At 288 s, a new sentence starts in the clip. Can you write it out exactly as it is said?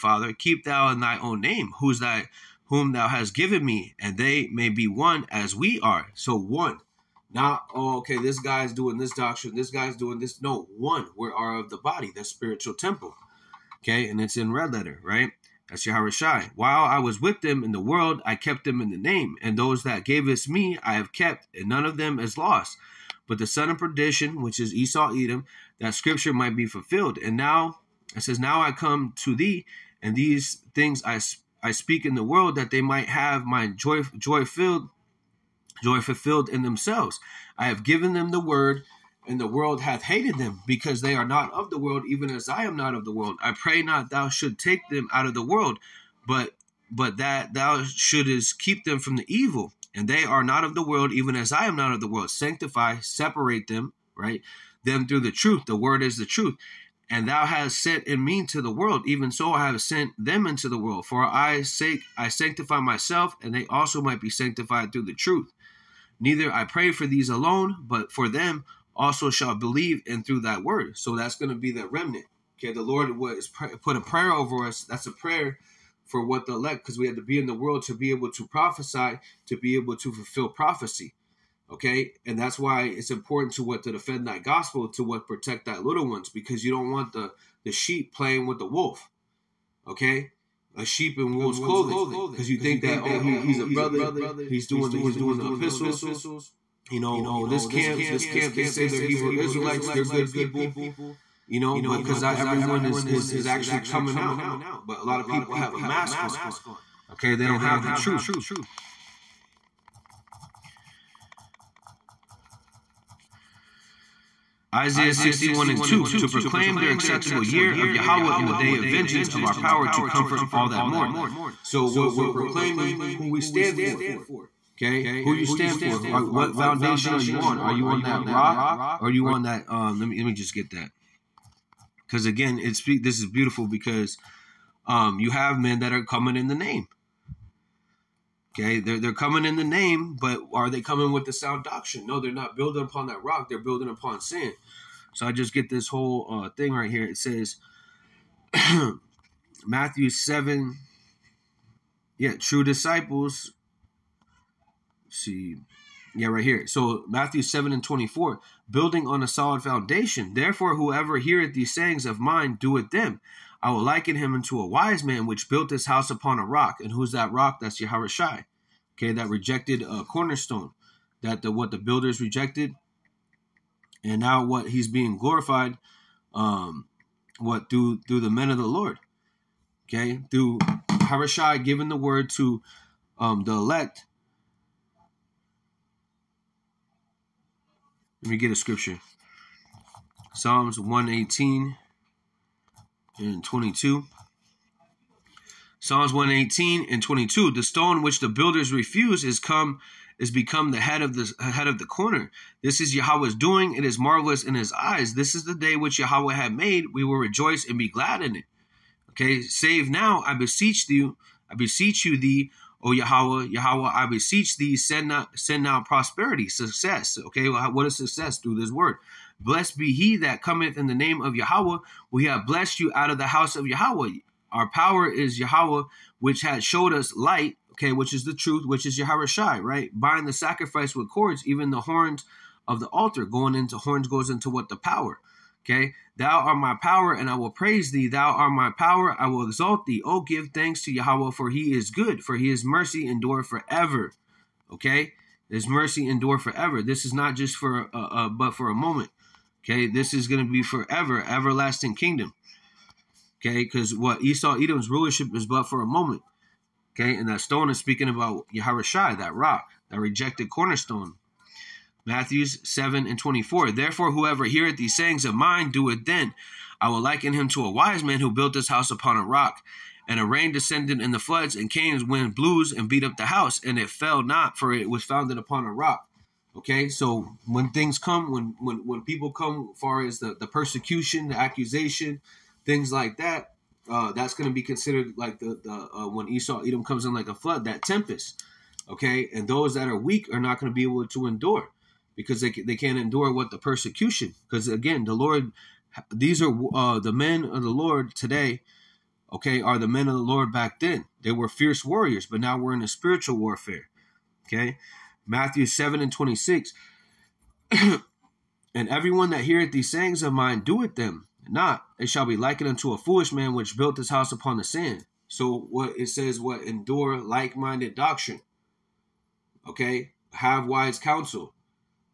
Okay, and those that are weak are not going to be able to endure because they they can't endure what the persecution.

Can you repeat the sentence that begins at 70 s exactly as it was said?
So that's going to be the remnant.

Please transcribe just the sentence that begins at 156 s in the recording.
So Matthew 7 and 24, building on a solid foundation.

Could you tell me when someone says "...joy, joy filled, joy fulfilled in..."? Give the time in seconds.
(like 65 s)
33 s.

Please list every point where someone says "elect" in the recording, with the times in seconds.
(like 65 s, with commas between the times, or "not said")
76 s, 183 s.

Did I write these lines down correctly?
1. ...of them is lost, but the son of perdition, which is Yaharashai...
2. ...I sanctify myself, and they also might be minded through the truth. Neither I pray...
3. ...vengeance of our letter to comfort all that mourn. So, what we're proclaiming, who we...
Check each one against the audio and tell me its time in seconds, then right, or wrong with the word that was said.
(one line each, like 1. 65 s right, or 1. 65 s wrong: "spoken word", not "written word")
1. 21 s wrong: "Esau", not "Yaharashai"
2. 62 s wrong: "sanctified", not "minded"
3. 118 s wrong: "power", not "letter".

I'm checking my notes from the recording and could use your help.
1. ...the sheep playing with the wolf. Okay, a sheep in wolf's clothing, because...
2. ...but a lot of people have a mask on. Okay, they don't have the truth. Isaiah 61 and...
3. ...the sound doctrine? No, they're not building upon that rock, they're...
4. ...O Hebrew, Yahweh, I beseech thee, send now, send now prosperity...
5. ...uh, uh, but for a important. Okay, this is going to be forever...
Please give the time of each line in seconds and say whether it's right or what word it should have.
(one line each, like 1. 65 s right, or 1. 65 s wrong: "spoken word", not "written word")
1. 87 s right
2. 104 s right
3. 141 s right
4. 212 s wrong: "Yahweh", not "Hebrew"
5. 247 s wrong: "moment", not "important".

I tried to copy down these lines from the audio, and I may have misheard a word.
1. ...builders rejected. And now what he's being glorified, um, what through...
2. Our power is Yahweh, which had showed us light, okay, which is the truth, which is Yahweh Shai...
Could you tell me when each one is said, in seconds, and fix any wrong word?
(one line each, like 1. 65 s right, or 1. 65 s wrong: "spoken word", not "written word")
1. 171 s right
2. 224 s right.